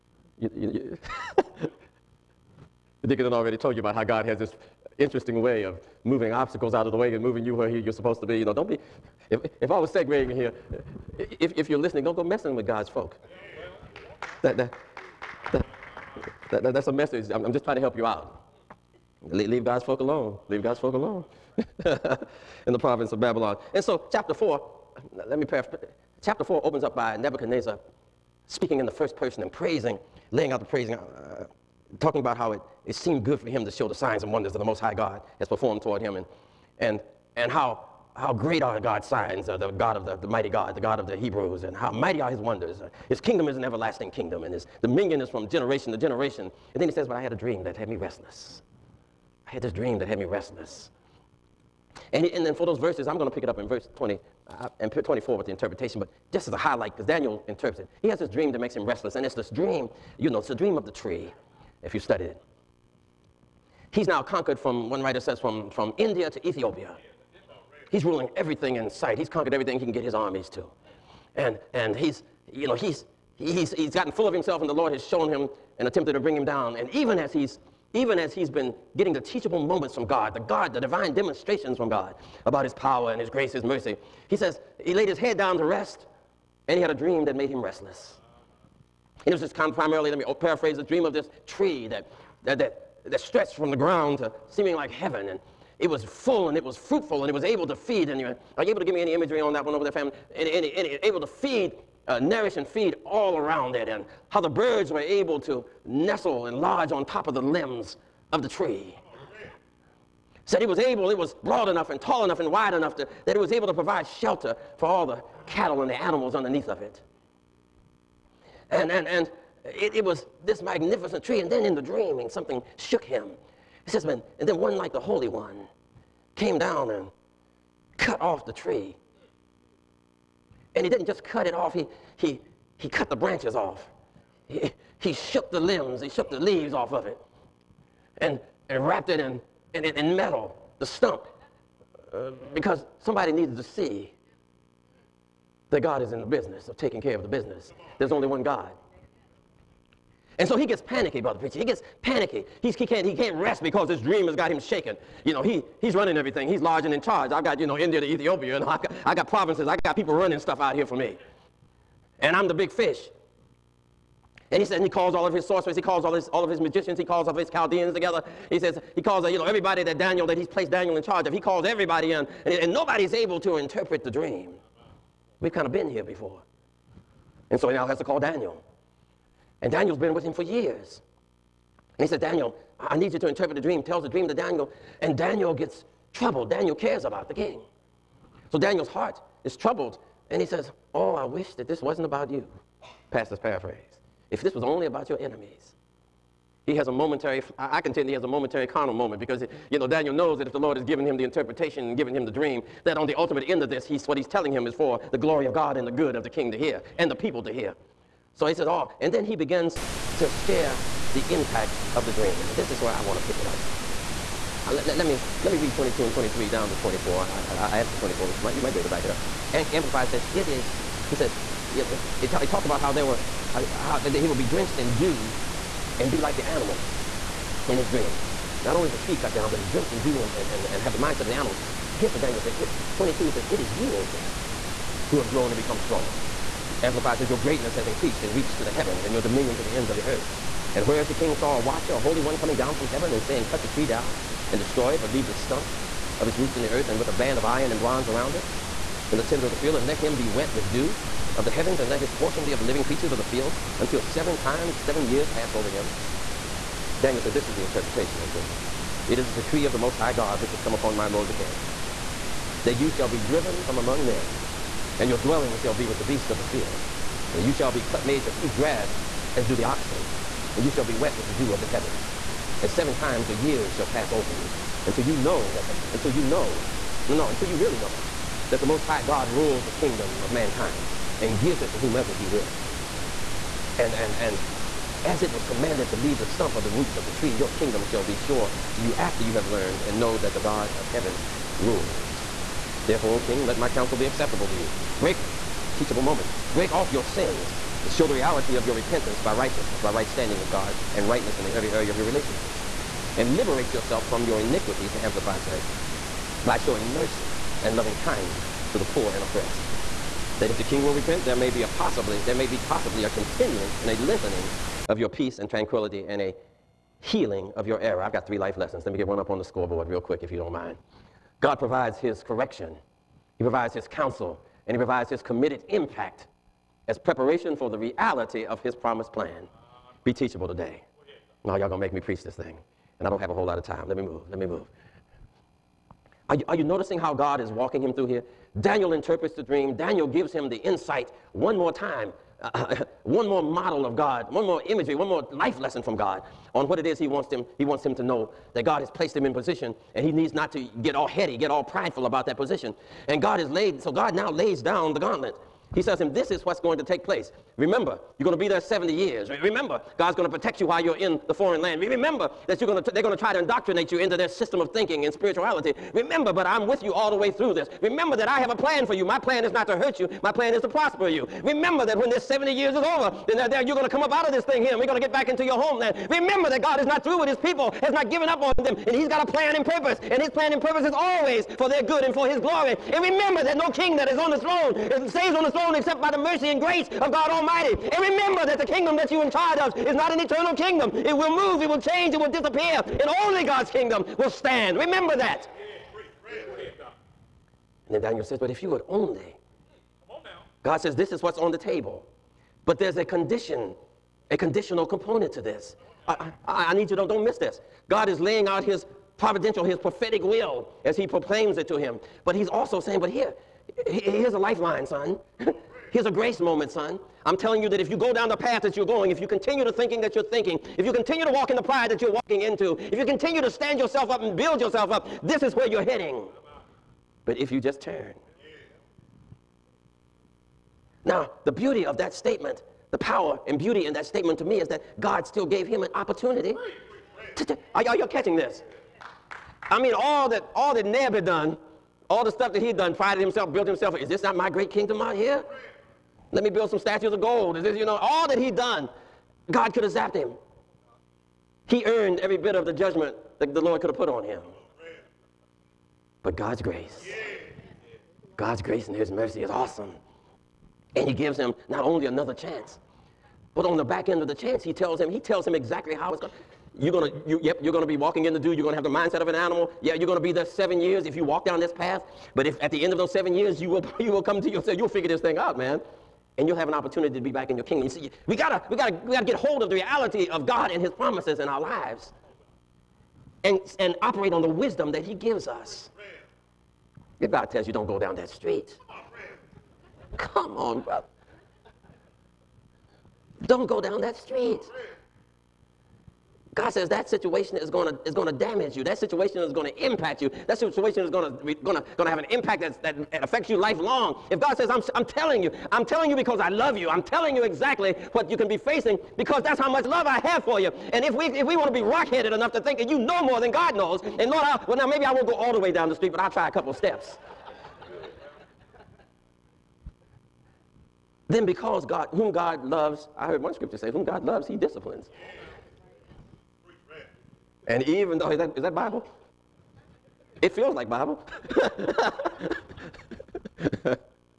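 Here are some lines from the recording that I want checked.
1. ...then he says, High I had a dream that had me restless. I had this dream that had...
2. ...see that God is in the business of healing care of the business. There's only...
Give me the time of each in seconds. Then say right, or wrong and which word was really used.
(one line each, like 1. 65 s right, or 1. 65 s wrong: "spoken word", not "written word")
1. 46 s wrong: "But", not "High"
2. 143 s wrong: "taking", not "healing".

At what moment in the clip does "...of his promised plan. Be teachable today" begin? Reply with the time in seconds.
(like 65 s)
328 s.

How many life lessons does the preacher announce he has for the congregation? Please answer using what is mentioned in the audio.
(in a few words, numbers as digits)
3.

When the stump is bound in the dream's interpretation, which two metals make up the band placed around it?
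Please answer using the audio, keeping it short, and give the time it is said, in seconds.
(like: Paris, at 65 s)
Iron and bronze, at 247 s.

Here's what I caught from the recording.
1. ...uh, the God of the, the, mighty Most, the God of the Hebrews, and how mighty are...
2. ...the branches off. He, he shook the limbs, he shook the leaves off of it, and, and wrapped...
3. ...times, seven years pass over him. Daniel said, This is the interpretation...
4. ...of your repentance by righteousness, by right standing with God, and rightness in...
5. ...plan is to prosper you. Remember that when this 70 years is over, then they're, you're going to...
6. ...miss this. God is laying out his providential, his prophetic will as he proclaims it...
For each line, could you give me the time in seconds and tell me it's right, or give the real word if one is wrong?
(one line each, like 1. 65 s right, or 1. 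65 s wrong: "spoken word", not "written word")
1. 39 s wrong: "God", not "Most"
2. 133 s right
3. 254 s right
4. 298 s right
5. 370 s right
6. 407 s right.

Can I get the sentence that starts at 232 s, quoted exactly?
It, 22, he says, It is you, O king, who have grown and become strong.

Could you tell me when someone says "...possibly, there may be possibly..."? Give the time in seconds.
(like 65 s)
311 s.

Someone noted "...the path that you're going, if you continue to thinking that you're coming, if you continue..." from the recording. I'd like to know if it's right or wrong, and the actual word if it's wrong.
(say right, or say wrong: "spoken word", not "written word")
wrong: "thinking", not "coming".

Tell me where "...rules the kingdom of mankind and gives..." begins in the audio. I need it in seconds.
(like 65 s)
279 s.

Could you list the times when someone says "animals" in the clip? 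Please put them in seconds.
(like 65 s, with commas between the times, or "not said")
115 s, 226 s, 231 s, 469 s.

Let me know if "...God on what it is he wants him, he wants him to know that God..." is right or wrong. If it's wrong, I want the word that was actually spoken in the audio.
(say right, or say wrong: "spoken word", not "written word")
right.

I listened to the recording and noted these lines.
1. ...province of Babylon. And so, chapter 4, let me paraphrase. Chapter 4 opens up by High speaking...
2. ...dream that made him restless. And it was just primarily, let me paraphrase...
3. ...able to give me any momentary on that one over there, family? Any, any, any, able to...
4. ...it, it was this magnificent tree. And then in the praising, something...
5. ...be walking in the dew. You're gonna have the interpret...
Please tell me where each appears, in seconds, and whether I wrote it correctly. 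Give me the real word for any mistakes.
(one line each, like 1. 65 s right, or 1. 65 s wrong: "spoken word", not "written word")
1. 22 s wrong: "Nebuchadnezzar", not "High"
2. 86 s right
3. 98 s wrong: "imagery", not "momentary"
4. 119 s wrong: "dreaming", not "praising"
5. 467 s wrong: "mindset", not "interpret".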